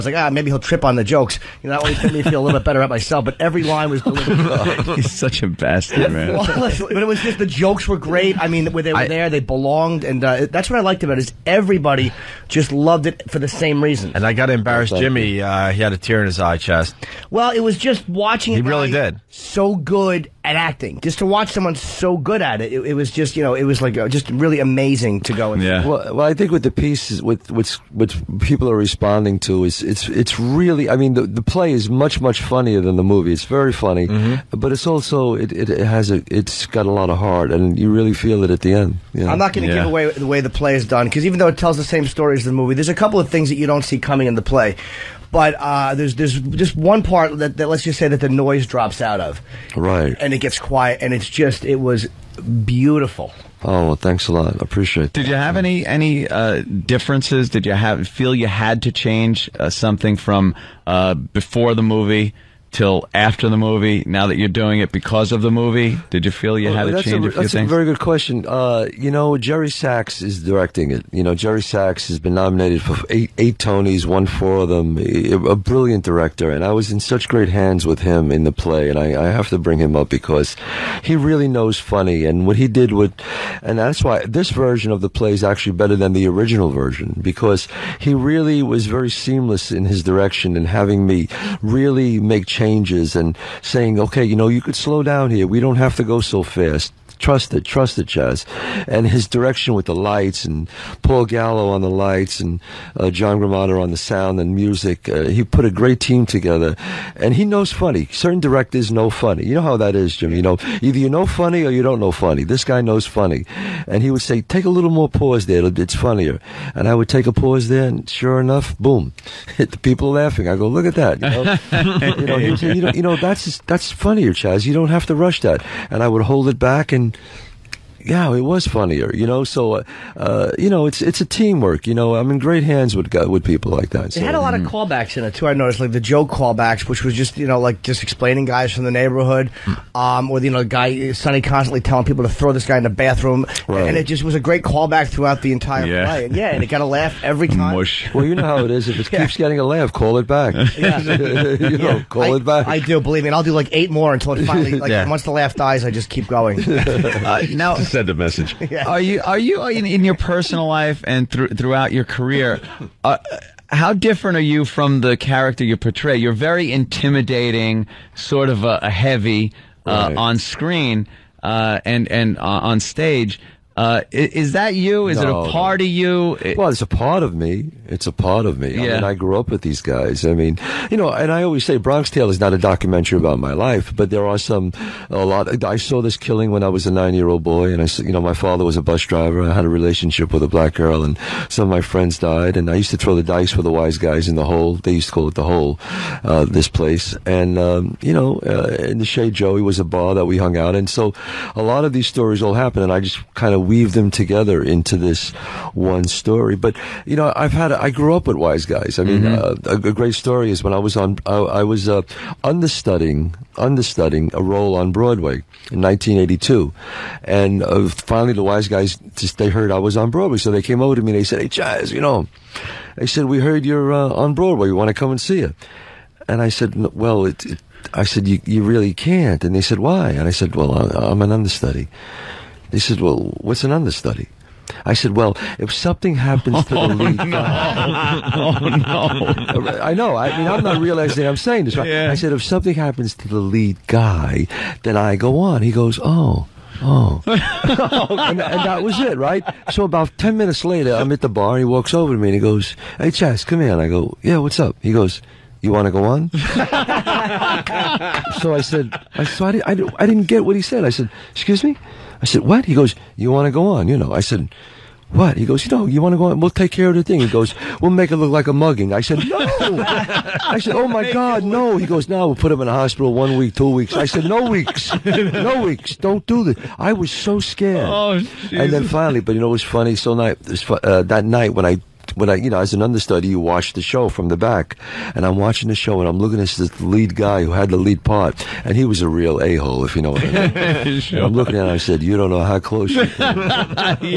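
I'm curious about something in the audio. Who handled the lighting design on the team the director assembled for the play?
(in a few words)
Paul Gallo.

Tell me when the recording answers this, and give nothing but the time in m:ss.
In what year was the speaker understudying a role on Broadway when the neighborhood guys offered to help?
3:35.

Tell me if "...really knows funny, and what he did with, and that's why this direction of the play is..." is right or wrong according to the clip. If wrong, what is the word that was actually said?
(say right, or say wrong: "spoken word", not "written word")
wrong: "version", not "direction".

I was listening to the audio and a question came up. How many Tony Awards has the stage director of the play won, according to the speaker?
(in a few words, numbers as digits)
4.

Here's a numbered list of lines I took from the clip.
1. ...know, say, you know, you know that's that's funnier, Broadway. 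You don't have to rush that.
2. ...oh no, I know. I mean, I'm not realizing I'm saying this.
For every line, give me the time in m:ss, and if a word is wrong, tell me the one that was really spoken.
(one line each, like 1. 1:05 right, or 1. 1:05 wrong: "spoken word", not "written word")
1. 2:02 wrong: "Chazz", not "Broadway"
2. 3:58 right.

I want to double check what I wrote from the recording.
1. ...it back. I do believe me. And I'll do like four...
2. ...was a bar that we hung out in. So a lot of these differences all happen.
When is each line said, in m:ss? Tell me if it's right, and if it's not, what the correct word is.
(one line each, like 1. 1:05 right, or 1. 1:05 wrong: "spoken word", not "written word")
1. 2:32 wrong: "eight", not "four"
2. 3:19 wrong: "stories", not "differences".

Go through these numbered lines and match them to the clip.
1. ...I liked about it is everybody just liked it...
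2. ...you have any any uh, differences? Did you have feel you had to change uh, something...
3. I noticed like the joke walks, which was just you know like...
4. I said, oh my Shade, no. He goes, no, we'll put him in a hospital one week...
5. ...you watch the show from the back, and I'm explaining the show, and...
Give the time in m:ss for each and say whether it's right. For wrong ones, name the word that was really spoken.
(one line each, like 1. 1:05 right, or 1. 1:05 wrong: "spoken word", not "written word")
1. 0:10 wrong: "loved", not "liked"
2. 0:55 right
3. 2:15 wrong: "callbacks", not "walks"
4. 4:29 wrong: "God", not "Shade"
5. 4:43 wrong: "watching", not "explaining".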